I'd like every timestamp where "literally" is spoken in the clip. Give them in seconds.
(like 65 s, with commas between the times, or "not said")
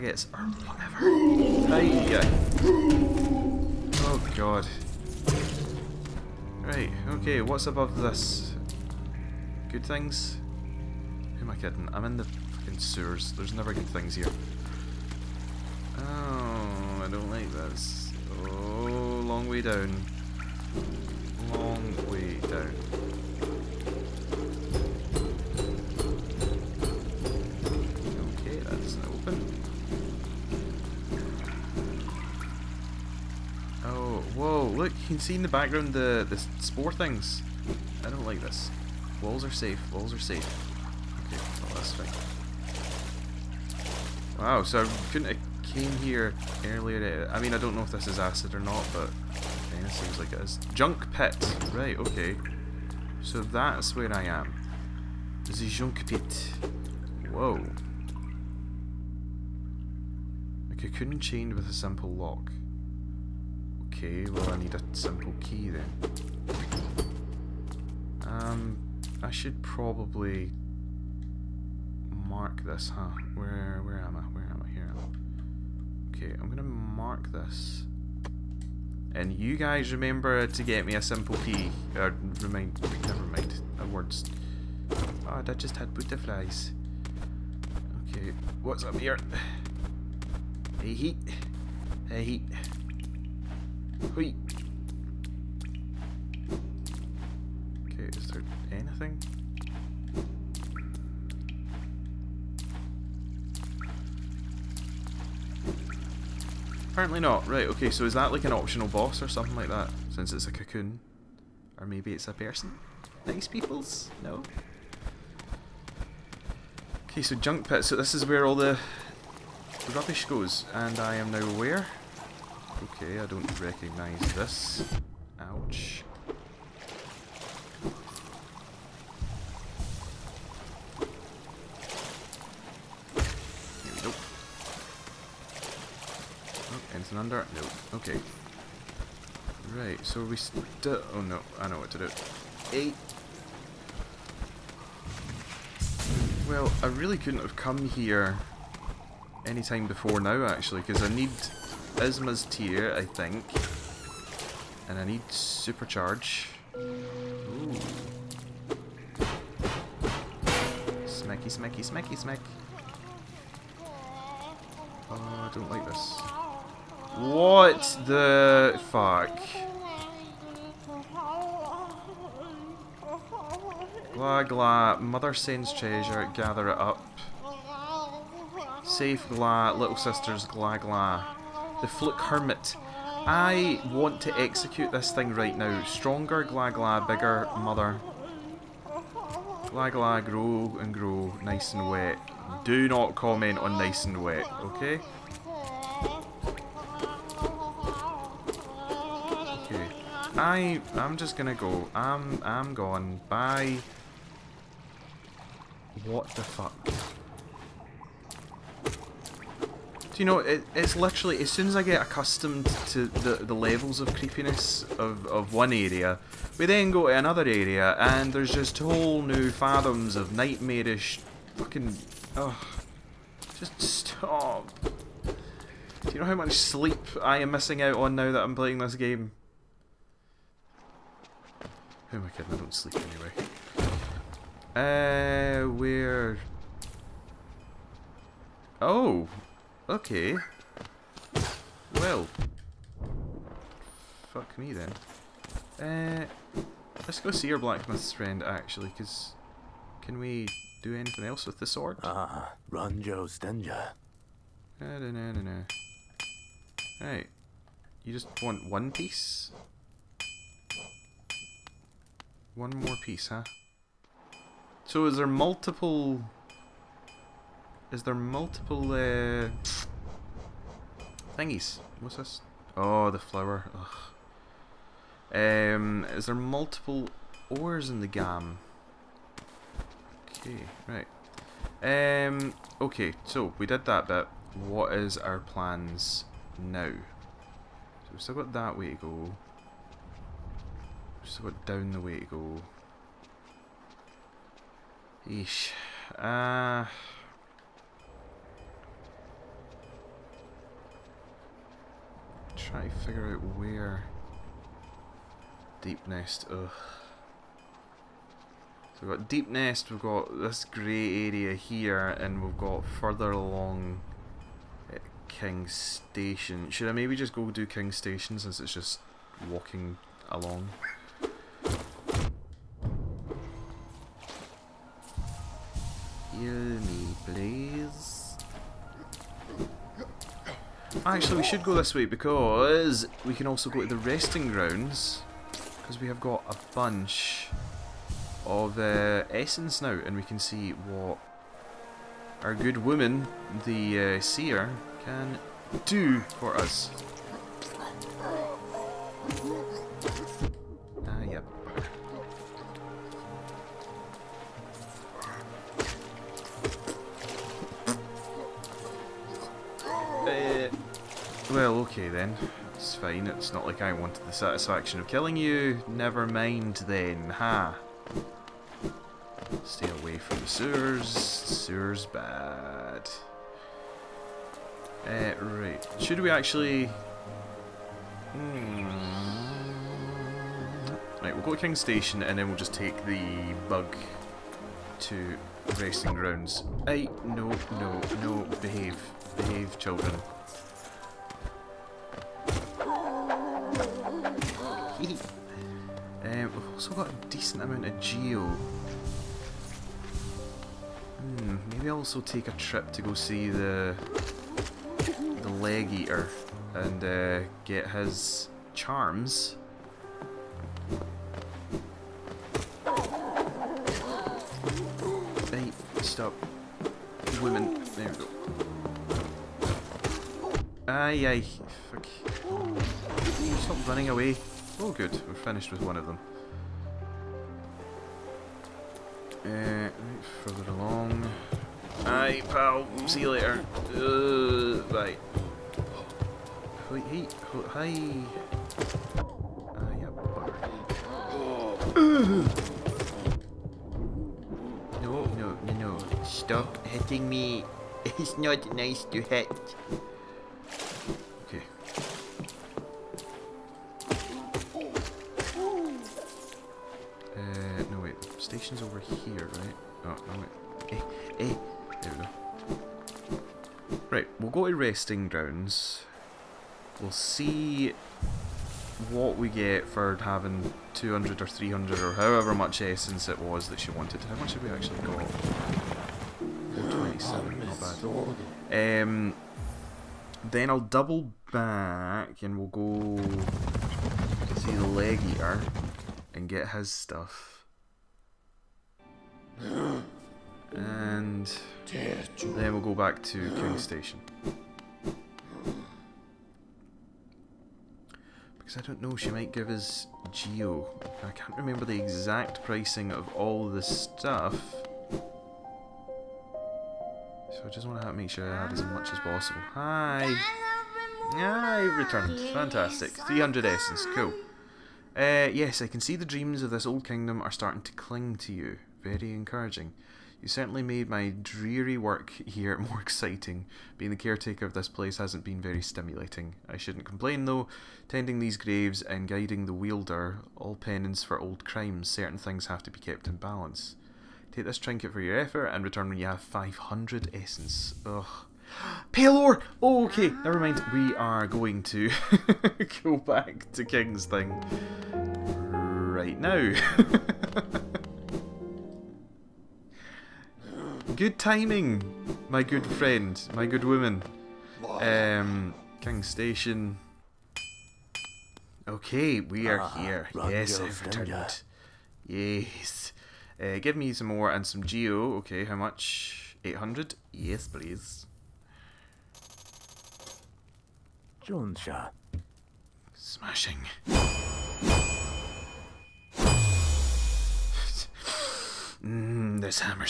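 210 s.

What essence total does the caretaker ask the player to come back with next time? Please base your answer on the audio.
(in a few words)
500.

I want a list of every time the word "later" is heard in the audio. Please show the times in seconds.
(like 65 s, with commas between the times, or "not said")
433 s.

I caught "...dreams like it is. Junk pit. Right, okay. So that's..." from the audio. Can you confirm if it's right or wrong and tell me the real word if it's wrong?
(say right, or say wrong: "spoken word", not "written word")
wrong: "seems", not "dreams".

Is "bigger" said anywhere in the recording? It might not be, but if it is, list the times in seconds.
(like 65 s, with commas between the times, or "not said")
187 s.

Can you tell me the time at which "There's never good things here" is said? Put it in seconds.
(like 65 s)
13 s.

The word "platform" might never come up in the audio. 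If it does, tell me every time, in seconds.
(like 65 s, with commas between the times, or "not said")
not said.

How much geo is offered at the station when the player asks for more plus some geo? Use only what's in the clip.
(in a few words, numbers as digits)
800.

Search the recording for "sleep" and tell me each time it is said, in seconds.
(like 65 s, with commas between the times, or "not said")
226 s, 232 s.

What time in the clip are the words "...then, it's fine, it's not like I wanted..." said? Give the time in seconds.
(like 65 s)
362 s.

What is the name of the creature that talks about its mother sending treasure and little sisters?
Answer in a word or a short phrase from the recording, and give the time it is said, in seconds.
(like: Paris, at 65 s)
The fluke hermit, at 181 s.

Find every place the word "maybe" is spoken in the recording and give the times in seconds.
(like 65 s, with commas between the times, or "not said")
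111 s, 316 s, 401 s.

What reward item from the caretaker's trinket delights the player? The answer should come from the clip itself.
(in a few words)
Pale ore.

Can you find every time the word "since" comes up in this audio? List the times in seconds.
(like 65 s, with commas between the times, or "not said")
110 s, 318 s.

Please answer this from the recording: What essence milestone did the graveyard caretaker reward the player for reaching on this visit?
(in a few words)
300.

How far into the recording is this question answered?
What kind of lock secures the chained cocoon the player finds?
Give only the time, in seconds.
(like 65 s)
61 s.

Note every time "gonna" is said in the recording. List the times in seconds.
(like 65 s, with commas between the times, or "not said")
76 s, 201 s.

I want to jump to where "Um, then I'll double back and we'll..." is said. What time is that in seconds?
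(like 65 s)
479 s.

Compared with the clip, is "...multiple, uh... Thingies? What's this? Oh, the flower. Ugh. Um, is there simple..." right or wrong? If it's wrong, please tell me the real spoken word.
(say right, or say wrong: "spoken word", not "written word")
wrong: "multiple", not "simple".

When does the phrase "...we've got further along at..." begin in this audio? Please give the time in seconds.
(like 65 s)
312 s.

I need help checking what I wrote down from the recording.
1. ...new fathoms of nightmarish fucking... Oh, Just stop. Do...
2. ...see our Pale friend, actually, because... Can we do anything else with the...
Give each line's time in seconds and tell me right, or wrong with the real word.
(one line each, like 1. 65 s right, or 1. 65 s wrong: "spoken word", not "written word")
1. 219 s right
2. 247 s wrong: "Black", not "Pale".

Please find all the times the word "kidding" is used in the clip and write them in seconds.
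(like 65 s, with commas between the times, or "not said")
11 s, 232 s.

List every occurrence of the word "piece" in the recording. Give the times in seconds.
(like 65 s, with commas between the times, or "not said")
258 s, 263 s.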